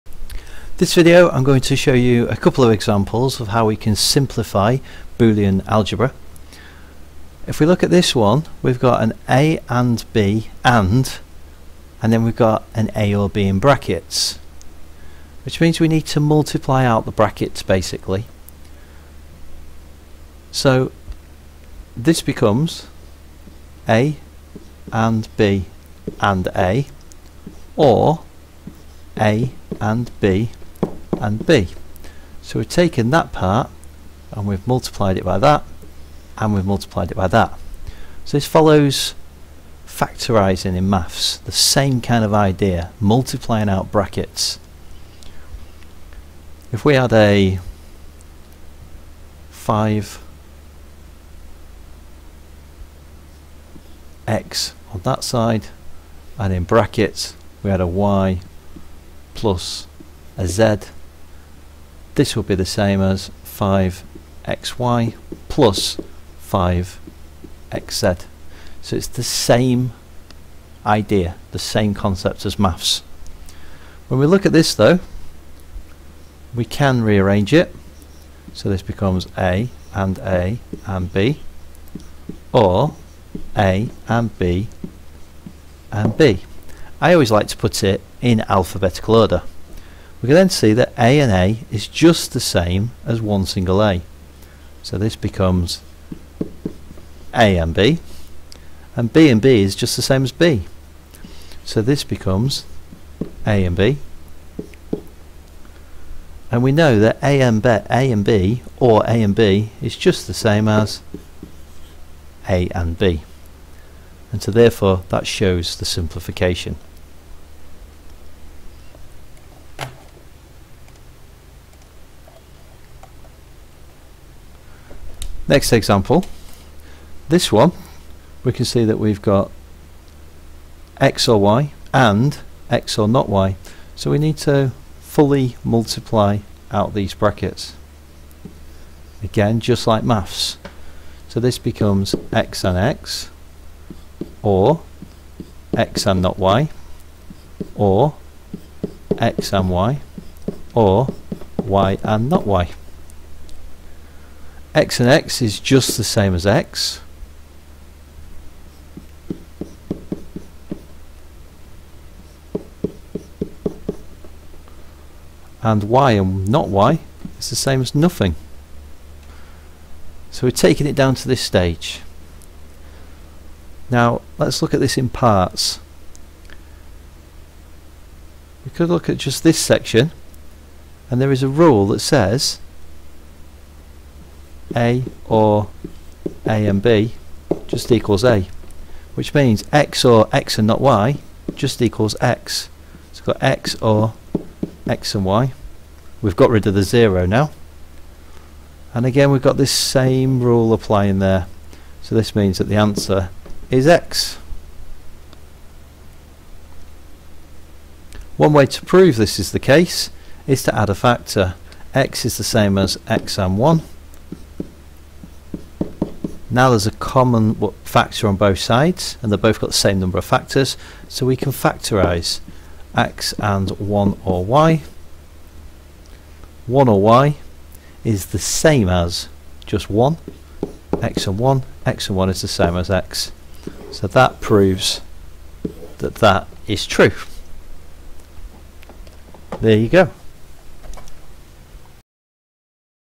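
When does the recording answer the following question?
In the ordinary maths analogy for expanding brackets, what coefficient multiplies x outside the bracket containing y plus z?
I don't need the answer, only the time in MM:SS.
00:49.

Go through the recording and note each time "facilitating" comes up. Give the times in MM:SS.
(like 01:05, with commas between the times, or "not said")
not said.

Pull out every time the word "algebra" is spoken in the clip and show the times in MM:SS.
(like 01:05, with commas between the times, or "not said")
00:05.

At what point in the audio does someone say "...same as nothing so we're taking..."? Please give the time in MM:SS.
02:47.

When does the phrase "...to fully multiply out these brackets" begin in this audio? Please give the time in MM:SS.
02:14.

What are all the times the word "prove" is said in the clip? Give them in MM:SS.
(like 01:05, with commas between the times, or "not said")
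03:28, 03:54.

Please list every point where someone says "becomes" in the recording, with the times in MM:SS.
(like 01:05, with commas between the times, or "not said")
00:22, 01:18, 01:35, 01:42, 02:21.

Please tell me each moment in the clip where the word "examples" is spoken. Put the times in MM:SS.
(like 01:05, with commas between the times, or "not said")
00:02, 02:05.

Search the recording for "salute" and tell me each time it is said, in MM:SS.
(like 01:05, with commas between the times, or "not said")
not said.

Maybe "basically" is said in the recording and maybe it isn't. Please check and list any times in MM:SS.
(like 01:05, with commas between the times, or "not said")
00:17.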